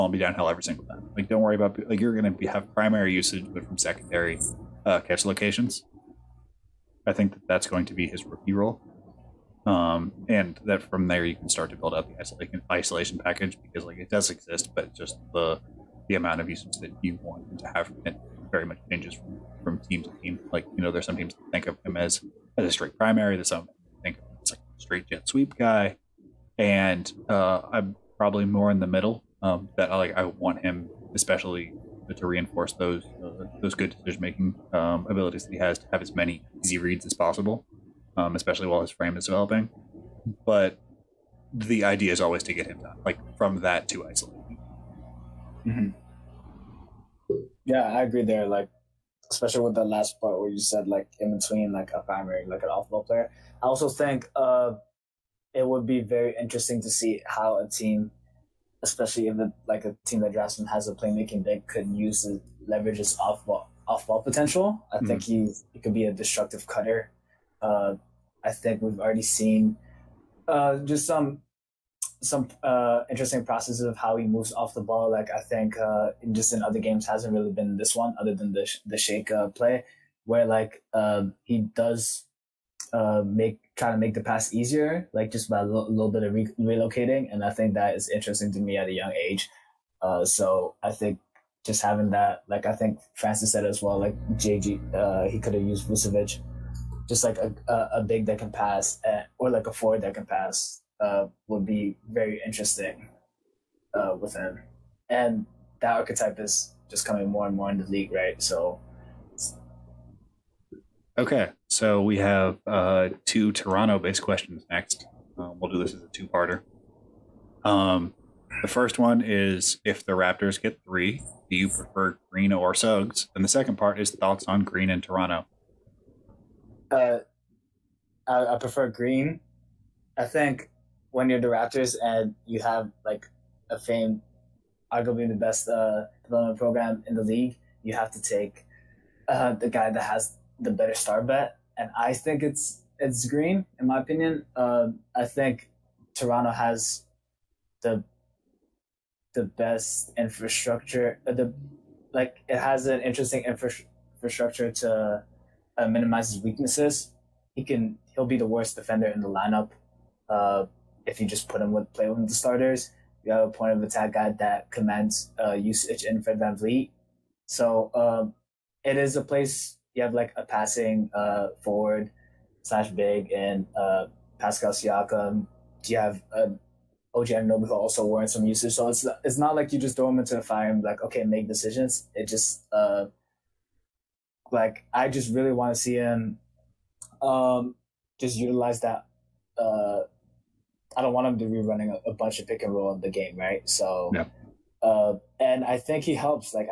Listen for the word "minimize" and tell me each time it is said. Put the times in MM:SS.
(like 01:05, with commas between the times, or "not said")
02:35.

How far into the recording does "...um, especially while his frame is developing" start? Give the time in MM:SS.
00:38.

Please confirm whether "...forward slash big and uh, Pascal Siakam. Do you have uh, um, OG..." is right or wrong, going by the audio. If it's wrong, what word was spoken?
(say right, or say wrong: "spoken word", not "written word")
right.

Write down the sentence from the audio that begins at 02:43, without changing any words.
You have a point of attack guy that commands uh, usage in Fred VanVleet.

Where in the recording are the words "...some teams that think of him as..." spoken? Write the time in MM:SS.
00:21.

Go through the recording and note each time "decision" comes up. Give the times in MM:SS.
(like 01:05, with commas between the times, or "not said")
00:33, 03:01.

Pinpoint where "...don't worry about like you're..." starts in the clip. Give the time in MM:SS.
00:01.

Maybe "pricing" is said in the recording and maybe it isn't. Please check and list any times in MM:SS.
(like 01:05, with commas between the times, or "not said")
not said.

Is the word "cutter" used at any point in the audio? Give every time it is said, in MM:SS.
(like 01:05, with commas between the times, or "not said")
01:06.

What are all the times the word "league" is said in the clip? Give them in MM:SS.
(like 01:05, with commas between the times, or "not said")
01:47, 02:17.